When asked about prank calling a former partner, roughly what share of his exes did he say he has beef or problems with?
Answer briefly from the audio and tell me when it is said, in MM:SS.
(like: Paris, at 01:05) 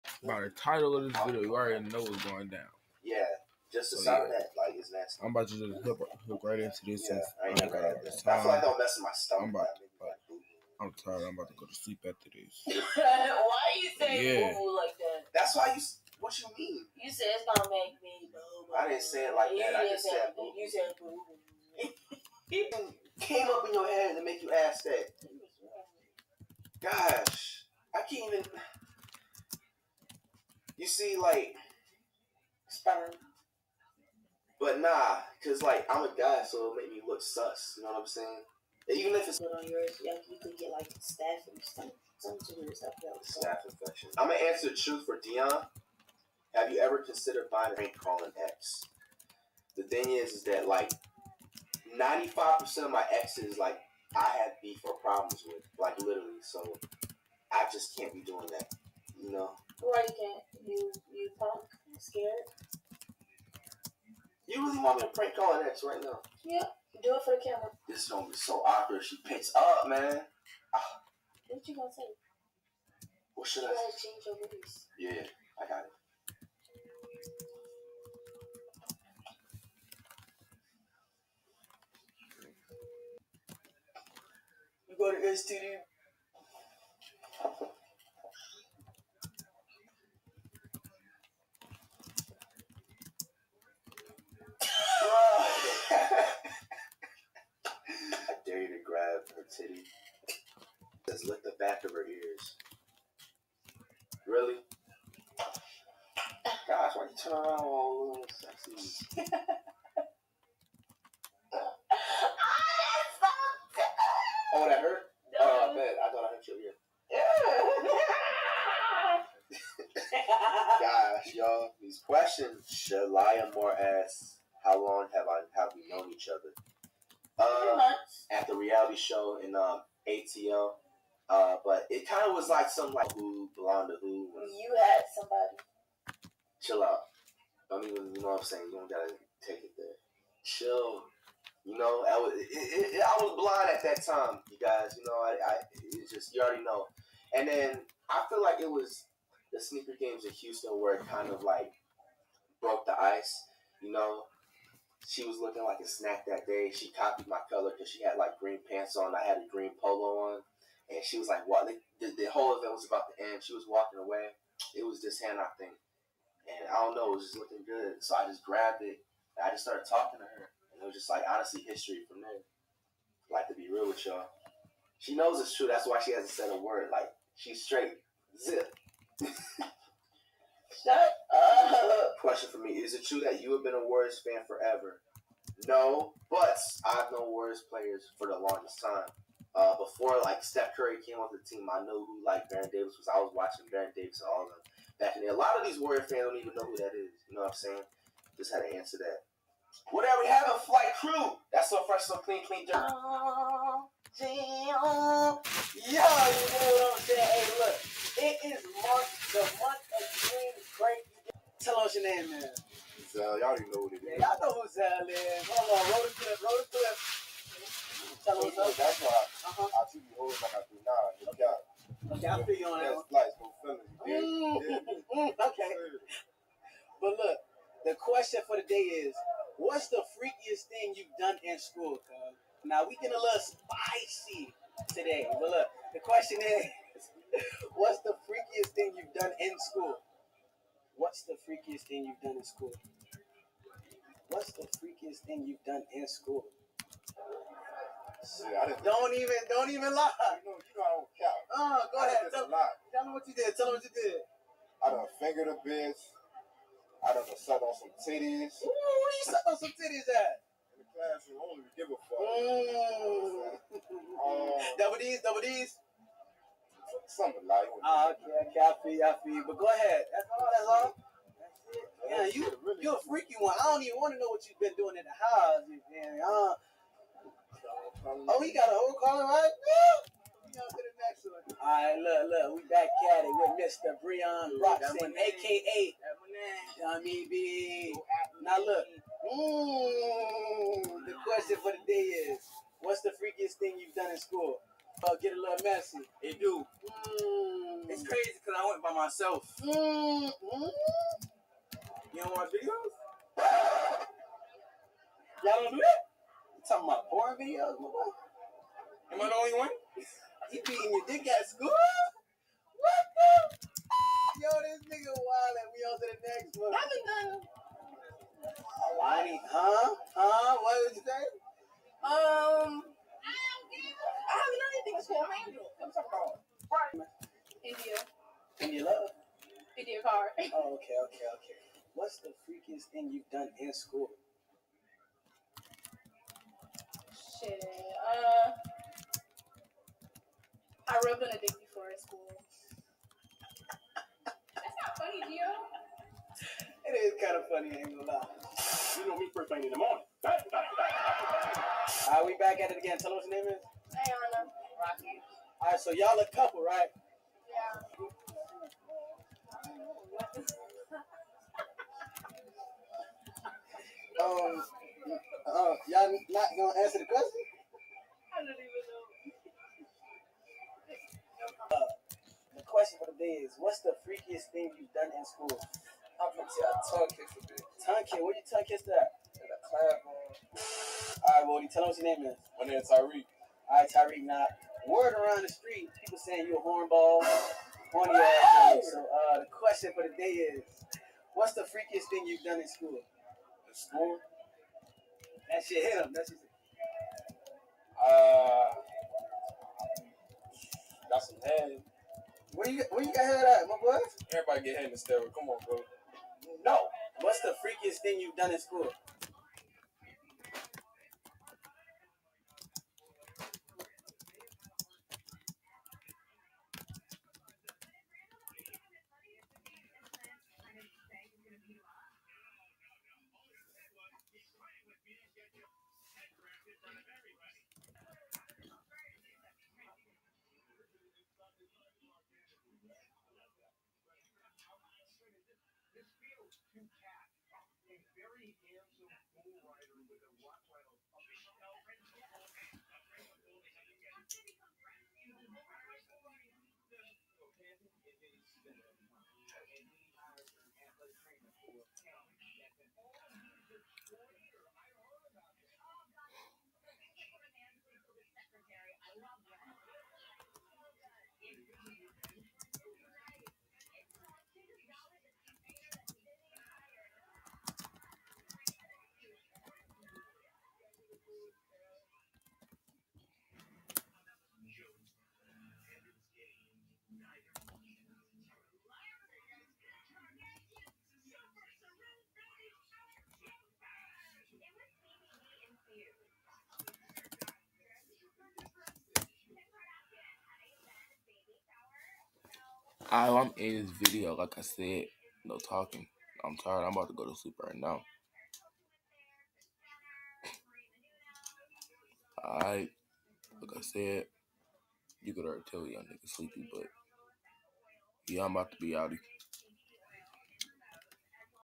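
95%, at 00:51.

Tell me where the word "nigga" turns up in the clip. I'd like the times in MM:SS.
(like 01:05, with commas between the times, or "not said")
05:14, 08:26.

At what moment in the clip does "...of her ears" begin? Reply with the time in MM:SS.
01:41.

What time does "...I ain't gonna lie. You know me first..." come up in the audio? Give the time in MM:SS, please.
05:47.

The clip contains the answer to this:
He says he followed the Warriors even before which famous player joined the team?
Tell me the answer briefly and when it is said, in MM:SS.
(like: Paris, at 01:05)
Steph Curry, at 03:10.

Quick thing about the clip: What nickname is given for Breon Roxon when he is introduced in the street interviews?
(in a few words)
Dummy B.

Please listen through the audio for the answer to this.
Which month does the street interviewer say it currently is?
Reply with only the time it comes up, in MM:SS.
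03:28.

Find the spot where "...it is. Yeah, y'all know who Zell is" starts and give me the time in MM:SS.
03:33.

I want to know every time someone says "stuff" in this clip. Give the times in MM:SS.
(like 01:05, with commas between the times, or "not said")
00:42.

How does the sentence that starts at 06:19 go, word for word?
In the class, All right, Bodie, tell them what your name is.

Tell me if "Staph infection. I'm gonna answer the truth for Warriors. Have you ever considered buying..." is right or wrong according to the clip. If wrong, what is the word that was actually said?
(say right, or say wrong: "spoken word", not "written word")
wrong: "Dion", not "Warriors".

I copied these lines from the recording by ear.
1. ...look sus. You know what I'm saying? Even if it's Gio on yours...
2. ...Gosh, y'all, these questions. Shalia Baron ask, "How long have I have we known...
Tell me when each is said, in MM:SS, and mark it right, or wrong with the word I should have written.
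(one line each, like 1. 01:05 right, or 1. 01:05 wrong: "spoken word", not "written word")
1. 00:37 wrong: "Put", not "Gio"
2. 02:00 wrong: "Moore", not "Baron".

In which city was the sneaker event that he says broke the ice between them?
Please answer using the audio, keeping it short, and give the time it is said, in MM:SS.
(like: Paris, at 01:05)
Houston, at 02:30.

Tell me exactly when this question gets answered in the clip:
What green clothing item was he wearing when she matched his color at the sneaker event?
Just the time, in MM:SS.
02:39.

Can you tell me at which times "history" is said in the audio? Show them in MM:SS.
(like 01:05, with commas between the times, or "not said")
02:51.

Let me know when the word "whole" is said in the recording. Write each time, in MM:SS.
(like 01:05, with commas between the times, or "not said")
02:42, 04:38.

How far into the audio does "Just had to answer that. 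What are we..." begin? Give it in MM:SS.
03:18.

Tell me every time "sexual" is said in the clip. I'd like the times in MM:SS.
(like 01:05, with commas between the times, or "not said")
not said.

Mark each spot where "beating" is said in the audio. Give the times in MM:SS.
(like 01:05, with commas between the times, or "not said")
05:10.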